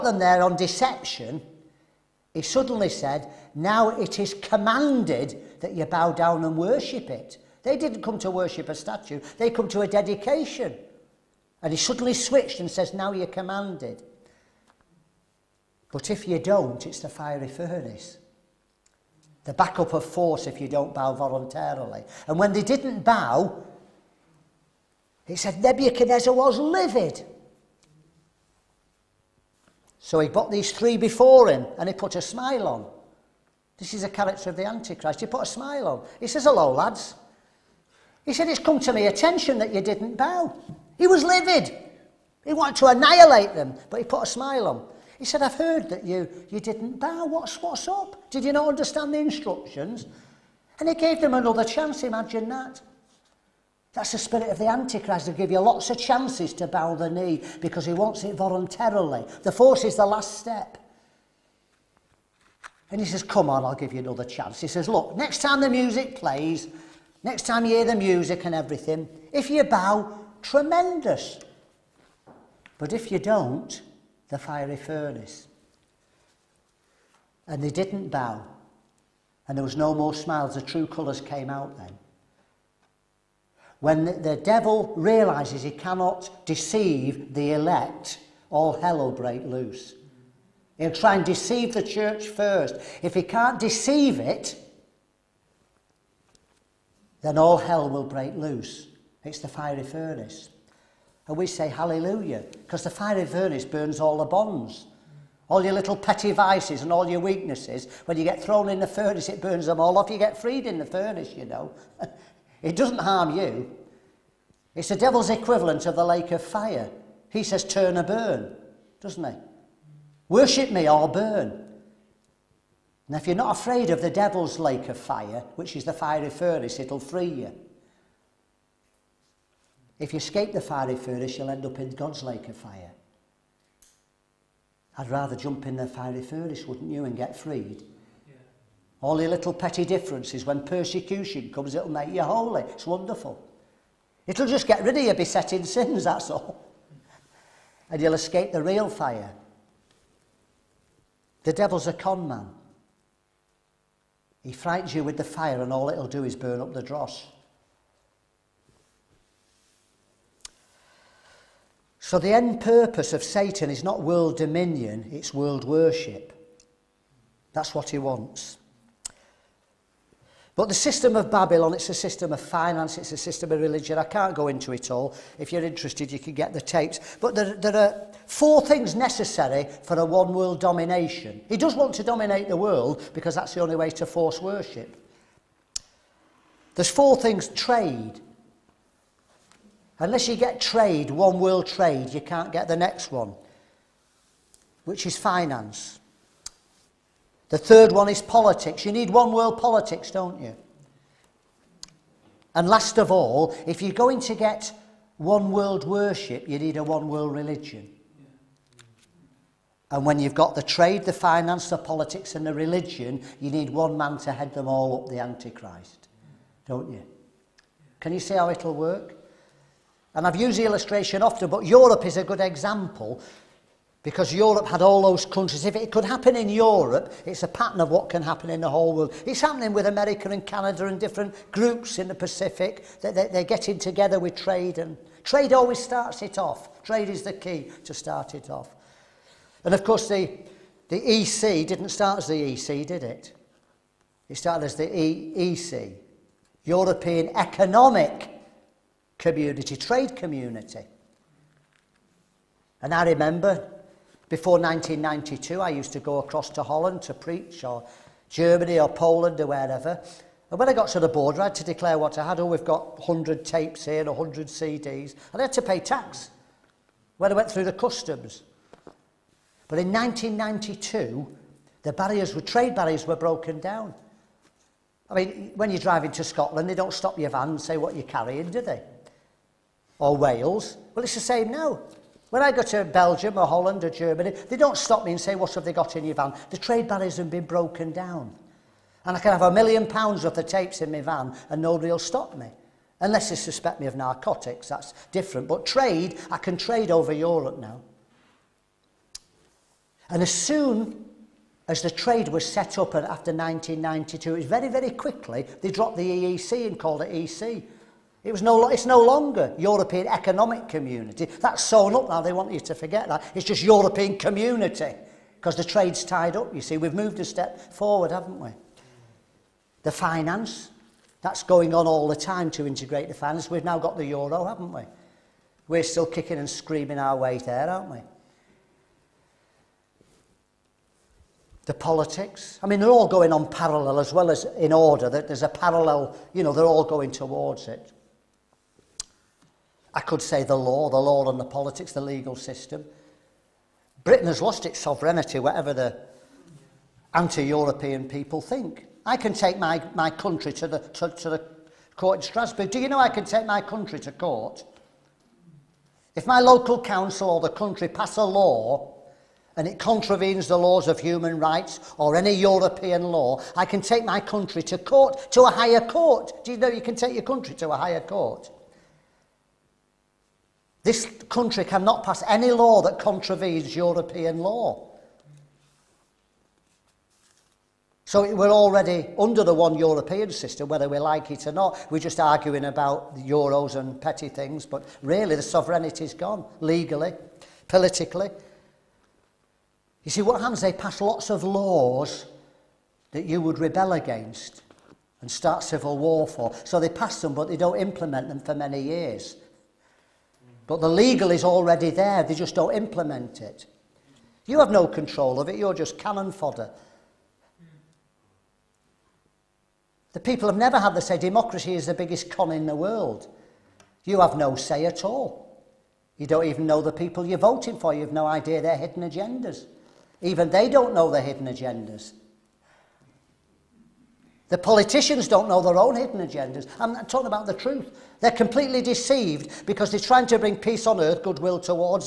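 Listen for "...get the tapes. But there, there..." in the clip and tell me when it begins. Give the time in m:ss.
2:56.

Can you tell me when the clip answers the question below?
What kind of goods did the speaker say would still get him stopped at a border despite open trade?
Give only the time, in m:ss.
4:53.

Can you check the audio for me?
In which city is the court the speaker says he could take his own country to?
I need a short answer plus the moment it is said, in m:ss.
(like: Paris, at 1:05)
Strasbourg, at 5:52.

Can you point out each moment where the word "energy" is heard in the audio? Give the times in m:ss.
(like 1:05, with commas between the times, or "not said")
not said.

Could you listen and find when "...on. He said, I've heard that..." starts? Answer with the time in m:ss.
0:44.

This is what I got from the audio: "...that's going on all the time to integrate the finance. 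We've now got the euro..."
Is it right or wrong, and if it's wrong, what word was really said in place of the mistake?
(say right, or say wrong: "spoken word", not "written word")
right.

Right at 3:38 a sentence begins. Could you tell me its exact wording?
Can you see how it'll work?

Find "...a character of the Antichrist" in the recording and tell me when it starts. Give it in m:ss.
0:34.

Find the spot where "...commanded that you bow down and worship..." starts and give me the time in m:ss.
0:04.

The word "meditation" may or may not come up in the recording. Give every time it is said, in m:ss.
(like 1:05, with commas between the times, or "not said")
not said.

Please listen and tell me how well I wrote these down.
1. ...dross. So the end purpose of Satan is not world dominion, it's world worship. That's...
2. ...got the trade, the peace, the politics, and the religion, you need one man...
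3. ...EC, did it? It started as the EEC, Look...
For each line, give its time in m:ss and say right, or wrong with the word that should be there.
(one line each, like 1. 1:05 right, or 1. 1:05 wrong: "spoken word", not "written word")
1. 2:36 right
2. 3:30 wrong: "finance", not "peace"
3. 4:02 wrong: "European", not "Look".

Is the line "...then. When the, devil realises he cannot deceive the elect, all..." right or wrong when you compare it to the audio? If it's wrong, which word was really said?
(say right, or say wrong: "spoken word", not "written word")
right.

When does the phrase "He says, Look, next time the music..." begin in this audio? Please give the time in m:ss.
1:04.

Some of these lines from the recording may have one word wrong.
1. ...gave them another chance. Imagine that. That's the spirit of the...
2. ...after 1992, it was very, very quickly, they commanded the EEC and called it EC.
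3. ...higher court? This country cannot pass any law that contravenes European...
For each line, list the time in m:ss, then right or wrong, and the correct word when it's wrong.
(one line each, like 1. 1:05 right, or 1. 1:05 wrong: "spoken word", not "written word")
1. 0:50 right
2. 5:02 wrong: "dropped", not "commanded"
3. 6:07 right.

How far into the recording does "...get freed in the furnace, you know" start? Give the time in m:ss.
1:50.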